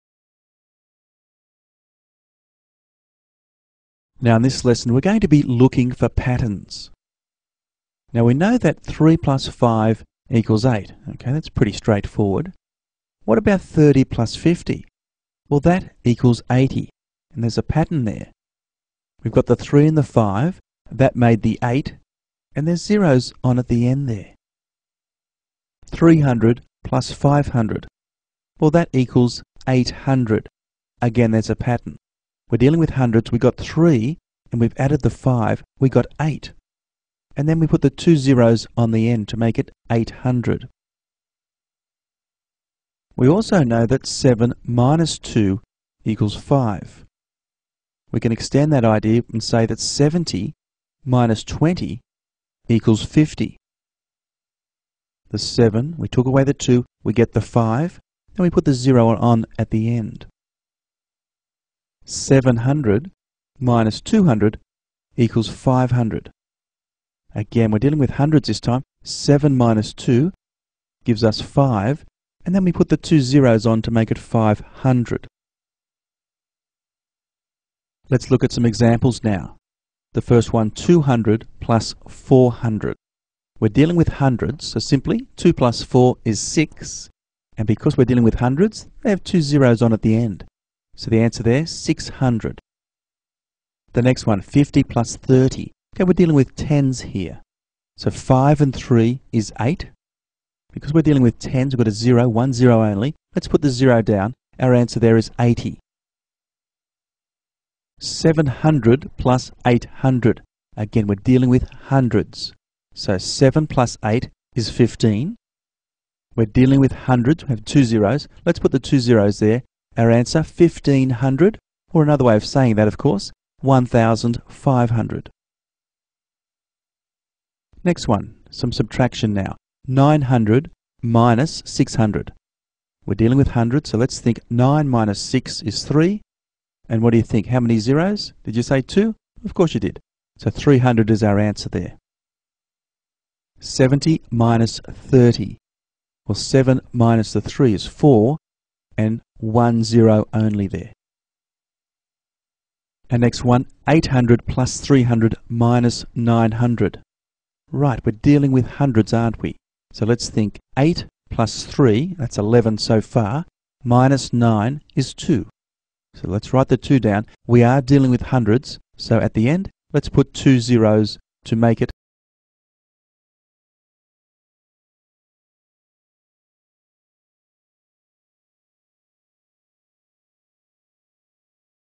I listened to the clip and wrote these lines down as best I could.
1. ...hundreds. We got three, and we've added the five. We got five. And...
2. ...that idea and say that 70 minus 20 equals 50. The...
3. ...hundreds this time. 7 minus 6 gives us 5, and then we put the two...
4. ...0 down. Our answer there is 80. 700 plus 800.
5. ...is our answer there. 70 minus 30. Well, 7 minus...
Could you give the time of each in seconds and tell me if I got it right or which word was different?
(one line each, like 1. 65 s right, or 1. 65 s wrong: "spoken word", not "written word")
1. 32 s wrong: "eight", not "five"
2. 48 s right
3. 68 s wrong: "2", not "6"
4. 103 s right
5. 141 s right.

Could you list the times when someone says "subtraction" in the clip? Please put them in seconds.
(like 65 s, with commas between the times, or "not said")
128 s.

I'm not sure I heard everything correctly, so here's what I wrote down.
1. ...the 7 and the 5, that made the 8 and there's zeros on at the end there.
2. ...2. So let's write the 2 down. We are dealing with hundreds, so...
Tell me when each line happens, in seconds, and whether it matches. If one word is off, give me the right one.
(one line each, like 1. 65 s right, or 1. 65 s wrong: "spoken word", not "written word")
1. 19 s wrong: "3", not "7"
2. 165 s right.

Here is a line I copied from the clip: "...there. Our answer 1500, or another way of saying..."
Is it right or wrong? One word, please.
right.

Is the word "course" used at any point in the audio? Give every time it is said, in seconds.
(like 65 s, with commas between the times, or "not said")
122 s, 139 s.